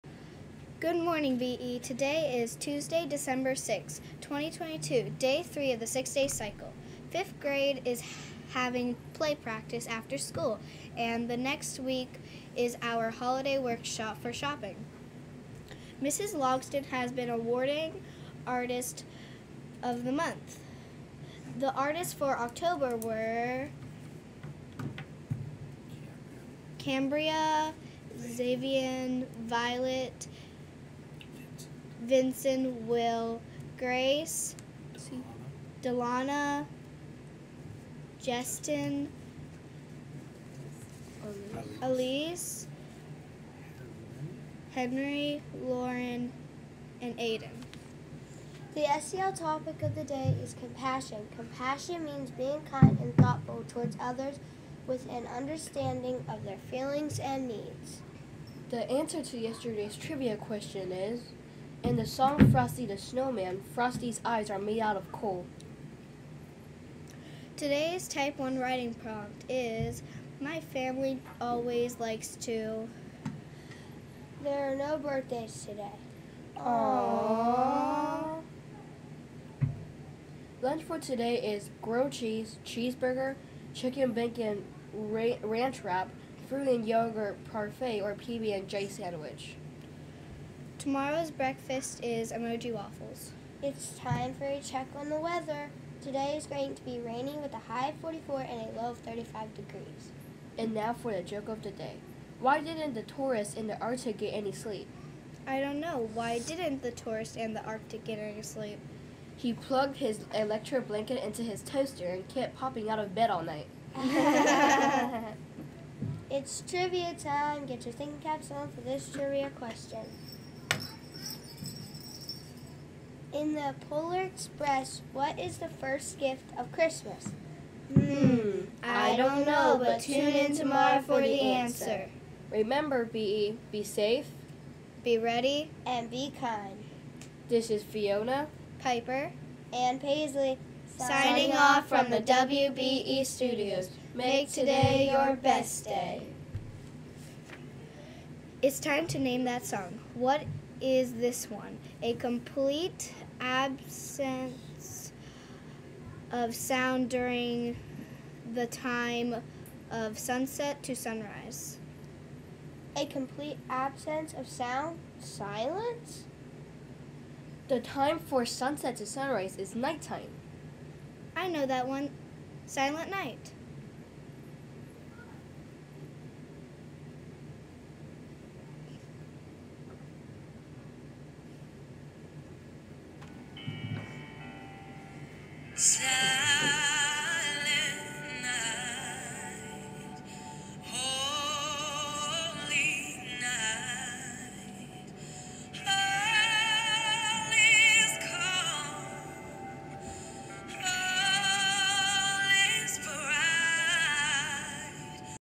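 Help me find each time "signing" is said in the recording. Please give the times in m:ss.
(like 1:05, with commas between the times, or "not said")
2:20.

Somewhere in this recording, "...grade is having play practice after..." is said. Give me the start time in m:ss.
0:07.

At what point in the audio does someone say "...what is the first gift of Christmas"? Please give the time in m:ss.
2:05.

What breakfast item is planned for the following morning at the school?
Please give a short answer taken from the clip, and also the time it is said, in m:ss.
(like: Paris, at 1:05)
Emoji waffles, at 1:32.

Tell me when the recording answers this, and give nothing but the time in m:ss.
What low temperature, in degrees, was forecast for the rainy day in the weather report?
1:38.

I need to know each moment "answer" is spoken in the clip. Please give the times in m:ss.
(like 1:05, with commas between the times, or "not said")
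0:58, 2:11.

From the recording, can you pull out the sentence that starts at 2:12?
Remember, BE, be safe, be ready, and be kind.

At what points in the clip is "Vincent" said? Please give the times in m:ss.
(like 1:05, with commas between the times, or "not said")
0:32.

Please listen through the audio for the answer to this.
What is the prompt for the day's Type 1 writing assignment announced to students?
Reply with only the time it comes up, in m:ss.
1:10.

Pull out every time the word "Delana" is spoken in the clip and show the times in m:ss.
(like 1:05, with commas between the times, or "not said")
0:35.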